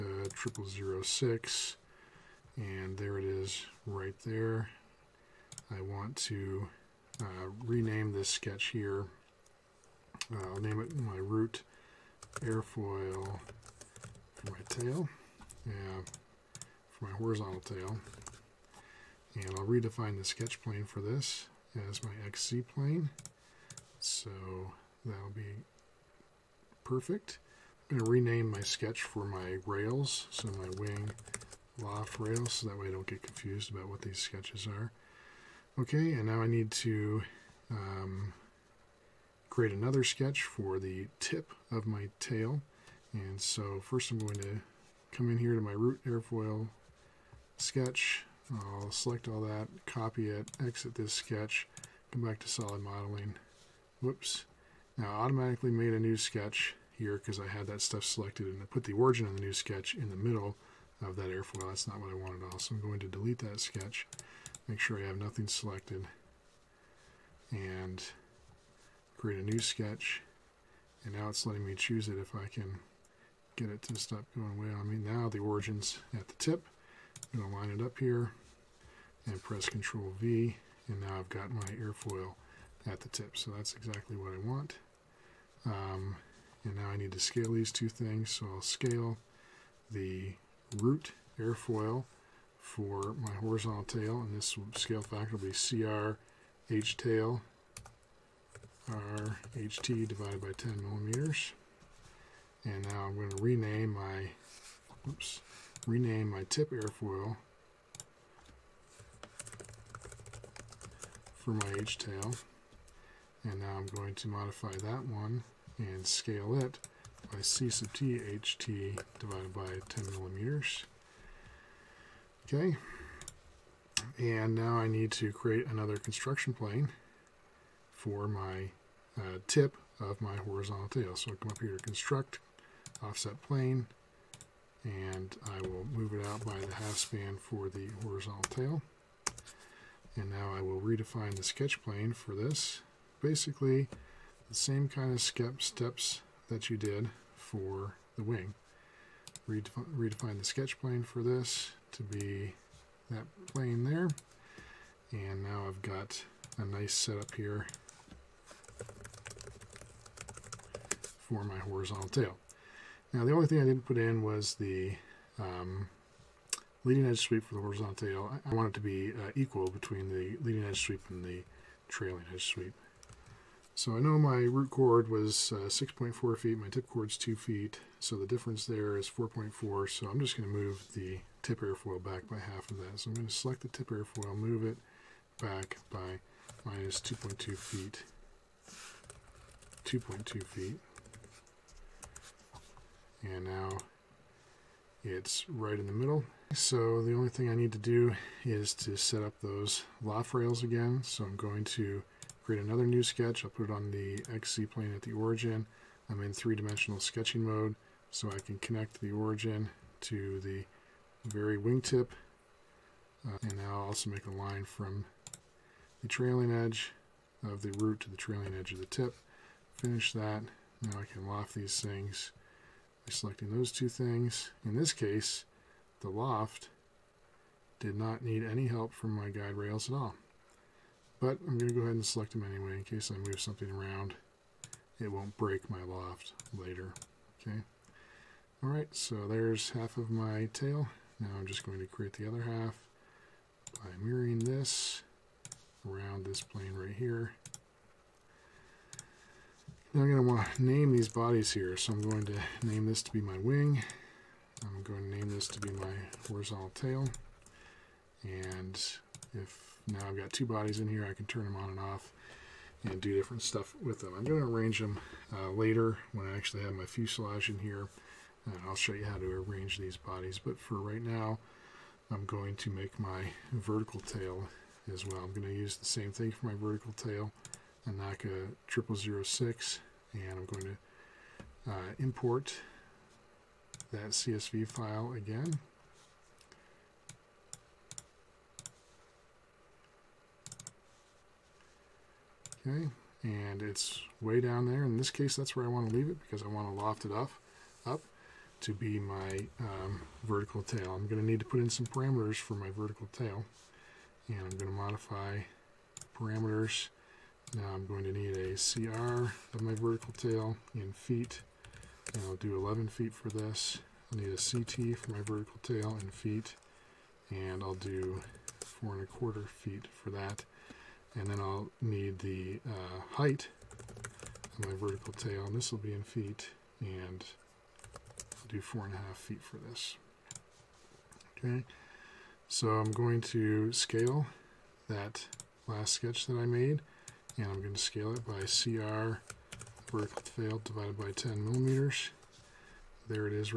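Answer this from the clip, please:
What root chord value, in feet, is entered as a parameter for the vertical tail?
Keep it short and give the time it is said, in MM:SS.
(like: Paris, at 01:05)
11 feet, at 05:12.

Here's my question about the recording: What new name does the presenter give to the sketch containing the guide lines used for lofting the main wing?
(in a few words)
wing loft rails.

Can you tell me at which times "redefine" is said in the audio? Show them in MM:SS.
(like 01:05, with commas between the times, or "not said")
00:19, 02:20, 02:29.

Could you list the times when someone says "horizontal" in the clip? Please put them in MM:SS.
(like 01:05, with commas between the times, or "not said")
00:17, 01:33, 02:10, 02:18, 02:41, 02:47, 04:16.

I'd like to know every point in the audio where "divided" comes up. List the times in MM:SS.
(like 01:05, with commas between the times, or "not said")
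01:40, 01:59, 05:40.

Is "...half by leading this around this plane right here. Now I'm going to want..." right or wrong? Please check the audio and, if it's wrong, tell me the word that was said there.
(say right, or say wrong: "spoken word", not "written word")
wrong: "mirroring", not "leading".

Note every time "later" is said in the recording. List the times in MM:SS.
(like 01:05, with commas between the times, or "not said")
03:56, 04:25.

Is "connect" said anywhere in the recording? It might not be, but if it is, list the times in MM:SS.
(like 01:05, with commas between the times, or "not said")
03:28.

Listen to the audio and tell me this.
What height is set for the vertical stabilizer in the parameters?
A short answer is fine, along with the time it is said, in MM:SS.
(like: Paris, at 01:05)
4.5 feet, at 05:28.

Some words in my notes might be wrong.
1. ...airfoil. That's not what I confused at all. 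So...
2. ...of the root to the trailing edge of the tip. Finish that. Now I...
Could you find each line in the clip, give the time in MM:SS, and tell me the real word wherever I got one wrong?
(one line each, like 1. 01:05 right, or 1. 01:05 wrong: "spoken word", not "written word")
1. 01:01 wrong: "wanted", not "confused"
2. 03:37 right.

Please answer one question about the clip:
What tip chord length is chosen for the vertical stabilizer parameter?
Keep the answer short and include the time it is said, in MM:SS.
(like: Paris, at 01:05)
4.25 feet, at 05:18.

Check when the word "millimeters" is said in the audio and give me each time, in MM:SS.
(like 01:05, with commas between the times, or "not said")
01:40, 02:00, 05:41.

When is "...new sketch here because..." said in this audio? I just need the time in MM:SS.
00:55.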